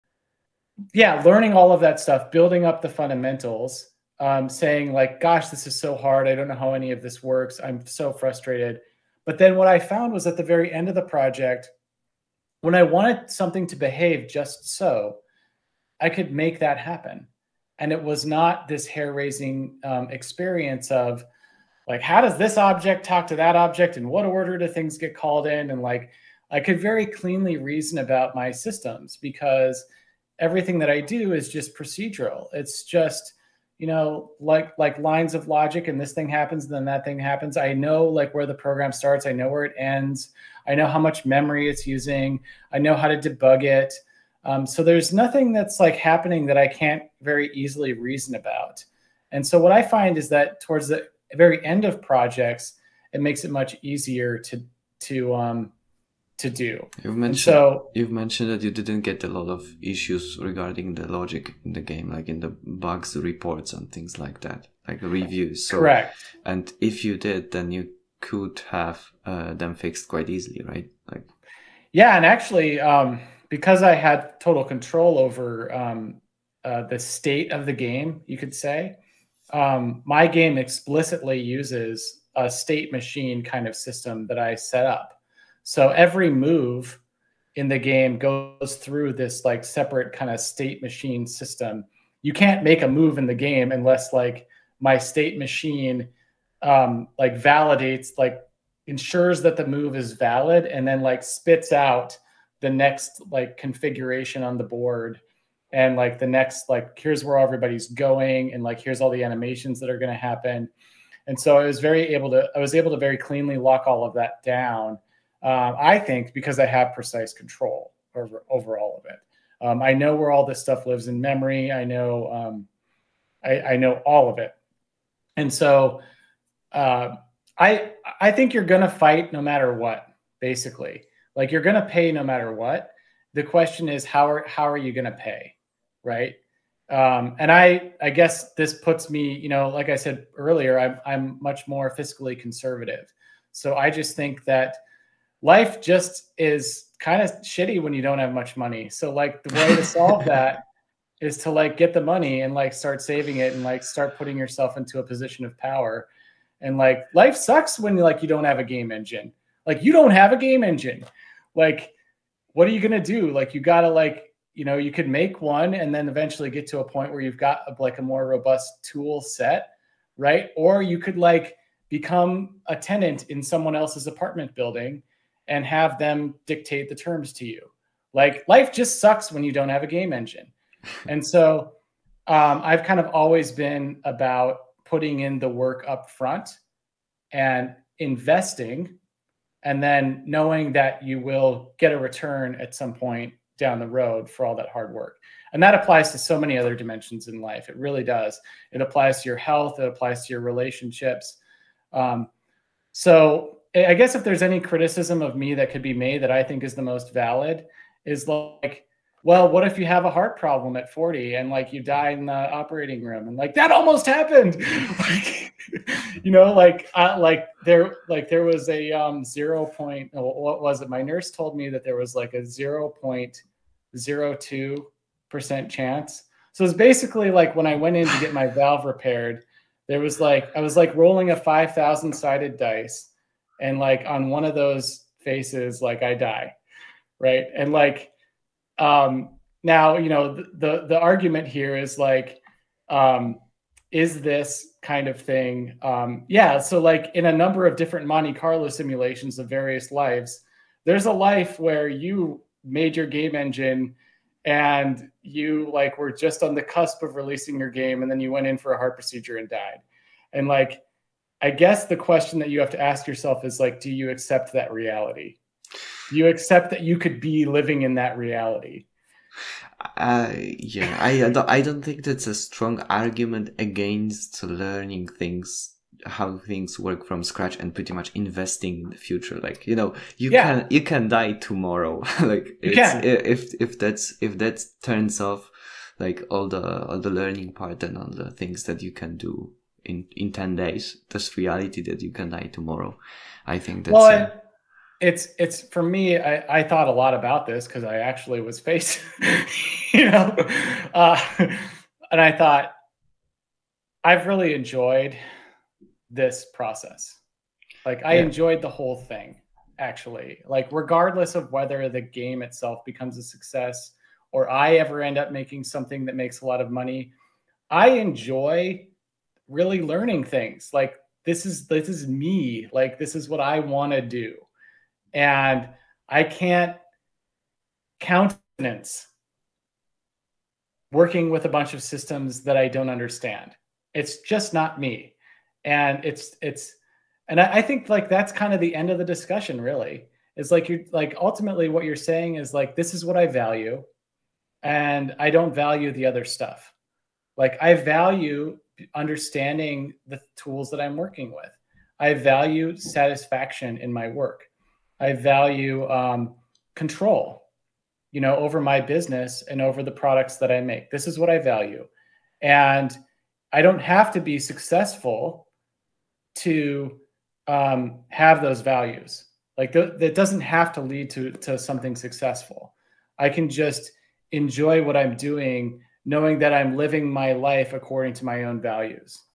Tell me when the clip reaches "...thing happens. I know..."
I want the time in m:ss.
0:37.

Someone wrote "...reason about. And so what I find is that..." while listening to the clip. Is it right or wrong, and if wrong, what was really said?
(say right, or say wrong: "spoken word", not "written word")
right.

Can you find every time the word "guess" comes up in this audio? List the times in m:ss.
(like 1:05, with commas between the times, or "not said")
2:18, 3:23, 4:21.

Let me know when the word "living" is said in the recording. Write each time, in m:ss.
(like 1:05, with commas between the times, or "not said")
4:27, 6:16.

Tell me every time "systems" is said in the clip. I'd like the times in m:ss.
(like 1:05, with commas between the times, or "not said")
0:28, 1:23, 1:31, 5:31.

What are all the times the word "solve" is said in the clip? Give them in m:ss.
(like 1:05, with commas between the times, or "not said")
2:29.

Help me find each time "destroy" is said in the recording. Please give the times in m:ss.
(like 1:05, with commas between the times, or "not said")
not said.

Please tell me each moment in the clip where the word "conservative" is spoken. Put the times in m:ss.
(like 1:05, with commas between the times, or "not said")
2:22.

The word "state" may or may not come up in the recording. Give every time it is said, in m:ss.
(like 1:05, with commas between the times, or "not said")
1:16, 1:22, 1:30, 1:34.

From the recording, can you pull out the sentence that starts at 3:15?
And that applies to so many other dimensions in life.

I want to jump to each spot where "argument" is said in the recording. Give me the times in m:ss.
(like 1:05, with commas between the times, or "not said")
4:00, 4:32.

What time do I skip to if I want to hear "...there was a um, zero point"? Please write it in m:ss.
3:38.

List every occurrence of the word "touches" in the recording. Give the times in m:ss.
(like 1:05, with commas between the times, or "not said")
not said.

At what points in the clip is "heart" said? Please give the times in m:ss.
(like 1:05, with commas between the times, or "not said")
3:30, 4:18.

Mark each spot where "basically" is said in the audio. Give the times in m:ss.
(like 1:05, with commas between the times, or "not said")
2:10, 3:46.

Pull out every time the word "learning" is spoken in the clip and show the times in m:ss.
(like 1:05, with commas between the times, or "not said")
0:01, 4:34, 4:47, 5:19.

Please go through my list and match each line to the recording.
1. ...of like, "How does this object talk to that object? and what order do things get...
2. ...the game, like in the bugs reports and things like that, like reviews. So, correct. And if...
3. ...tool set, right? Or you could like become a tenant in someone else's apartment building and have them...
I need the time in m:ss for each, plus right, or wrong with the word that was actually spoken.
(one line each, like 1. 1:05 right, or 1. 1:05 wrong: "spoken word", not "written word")
1. 0:20 right
2. 1:01 right
3. 2:48 right.